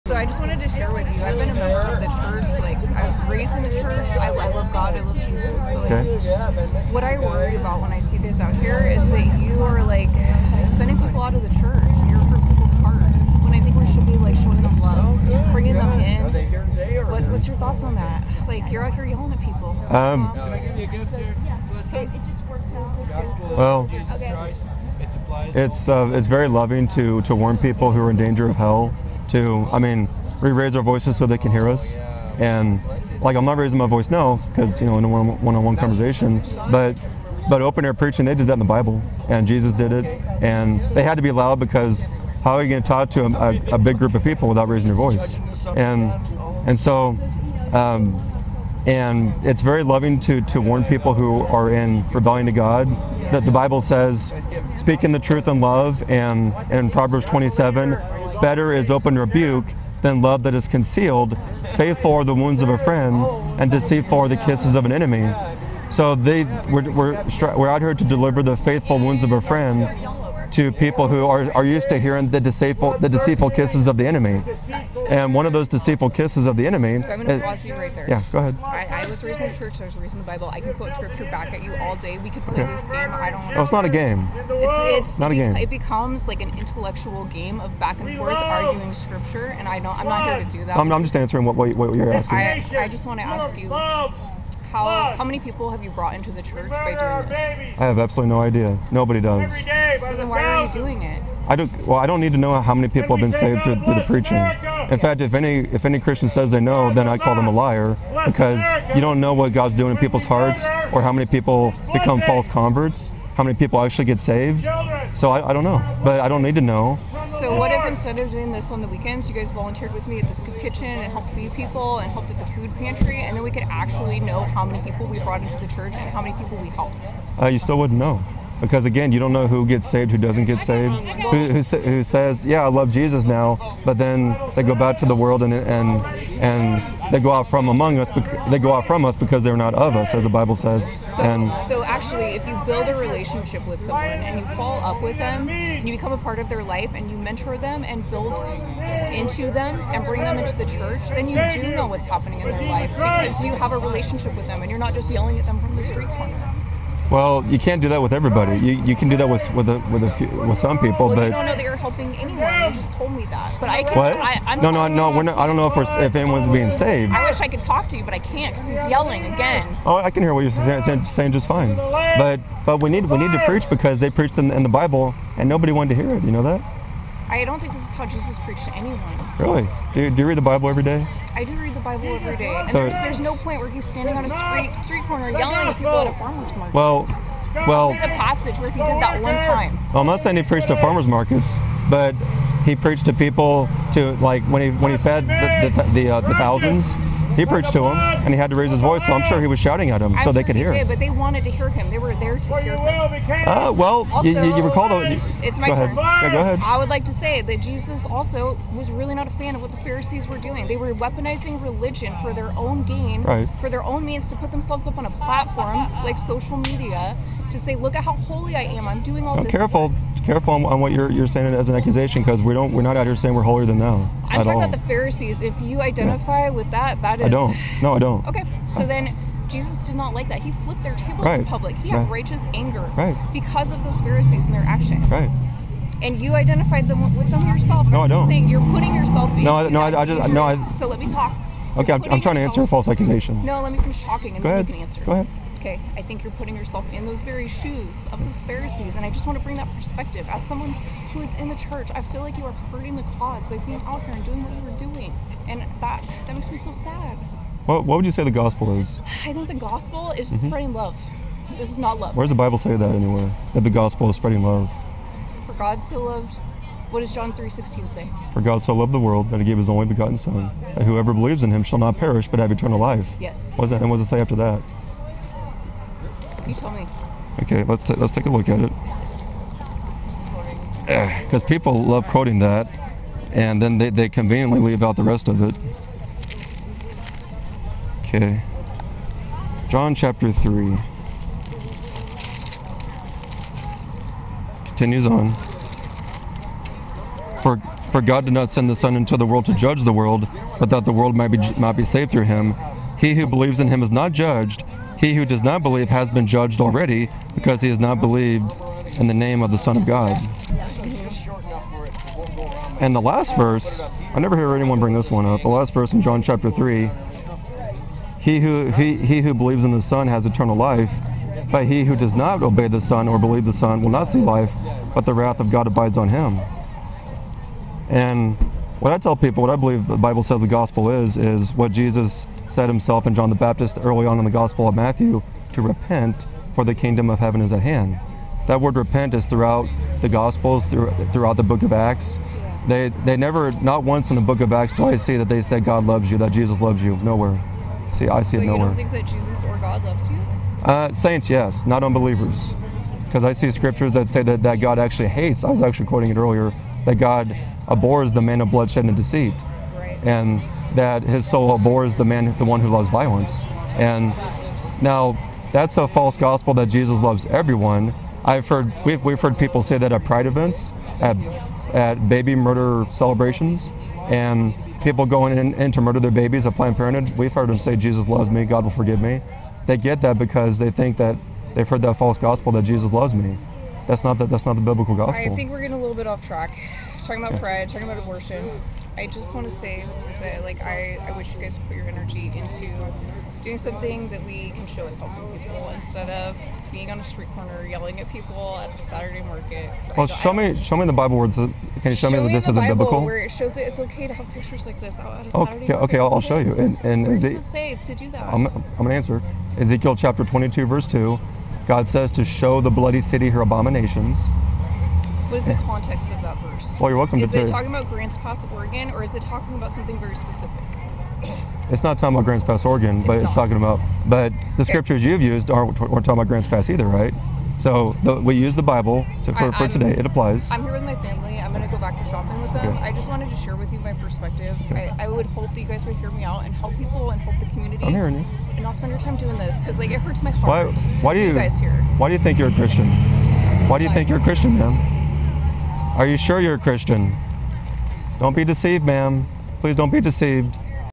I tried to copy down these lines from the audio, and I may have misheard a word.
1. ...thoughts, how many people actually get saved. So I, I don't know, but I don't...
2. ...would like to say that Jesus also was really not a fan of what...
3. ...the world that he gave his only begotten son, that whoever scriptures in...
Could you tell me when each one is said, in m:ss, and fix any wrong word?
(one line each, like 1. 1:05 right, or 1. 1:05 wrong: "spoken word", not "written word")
1. 1:52 wrong: "converts", not "thoughts"
2. 3:26 right
3. 4:28 wrong: "believes", not "scriptures".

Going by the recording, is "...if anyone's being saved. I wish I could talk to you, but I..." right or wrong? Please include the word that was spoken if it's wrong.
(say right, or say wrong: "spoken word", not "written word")
right.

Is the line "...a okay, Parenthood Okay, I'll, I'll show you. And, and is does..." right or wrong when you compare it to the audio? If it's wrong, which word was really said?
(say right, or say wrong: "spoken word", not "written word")
wrong: "Saturday", not "Parenthood".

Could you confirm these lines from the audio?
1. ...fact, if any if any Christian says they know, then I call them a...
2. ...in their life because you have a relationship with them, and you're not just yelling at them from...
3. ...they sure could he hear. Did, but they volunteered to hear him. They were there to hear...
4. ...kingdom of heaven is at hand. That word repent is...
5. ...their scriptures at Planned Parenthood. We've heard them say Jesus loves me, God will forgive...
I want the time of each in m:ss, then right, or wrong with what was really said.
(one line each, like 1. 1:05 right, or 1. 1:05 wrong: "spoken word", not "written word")
1. 1:44 right
2. 2:32 right
3. 3:20 wrong: "wanted", not "volunteered"
4. 5:36 right
5. 6:16 wrong: "babies", not "scriptures".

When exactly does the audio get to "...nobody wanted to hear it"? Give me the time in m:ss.
2:55.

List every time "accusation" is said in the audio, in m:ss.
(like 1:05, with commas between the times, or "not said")
3:41, 4:02.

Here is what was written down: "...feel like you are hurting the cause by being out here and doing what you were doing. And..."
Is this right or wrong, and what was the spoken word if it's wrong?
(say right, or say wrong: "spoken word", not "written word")
right.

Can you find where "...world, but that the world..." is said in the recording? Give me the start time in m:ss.
4:59.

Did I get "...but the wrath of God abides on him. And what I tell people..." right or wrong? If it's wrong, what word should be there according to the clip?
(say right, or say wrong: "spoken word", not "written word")
right.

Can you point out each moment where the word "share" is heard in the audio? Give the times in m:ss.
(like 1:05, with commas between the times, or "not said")
0:00, 7:13.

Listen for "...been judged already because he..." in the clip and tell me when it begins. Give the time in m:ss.
5:06.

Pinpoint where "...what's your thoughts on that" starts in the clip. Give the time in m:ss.
0:17.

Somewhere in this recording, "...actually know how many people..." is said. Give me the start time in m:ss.
2:03.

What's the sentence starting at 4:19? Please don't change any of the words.
I think the gospel is mm-hmm.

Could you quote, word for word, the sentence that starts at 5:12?
And the last verse, I never hear anyone bring this one up.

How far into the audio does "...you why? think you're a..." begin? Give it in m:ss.
7:23.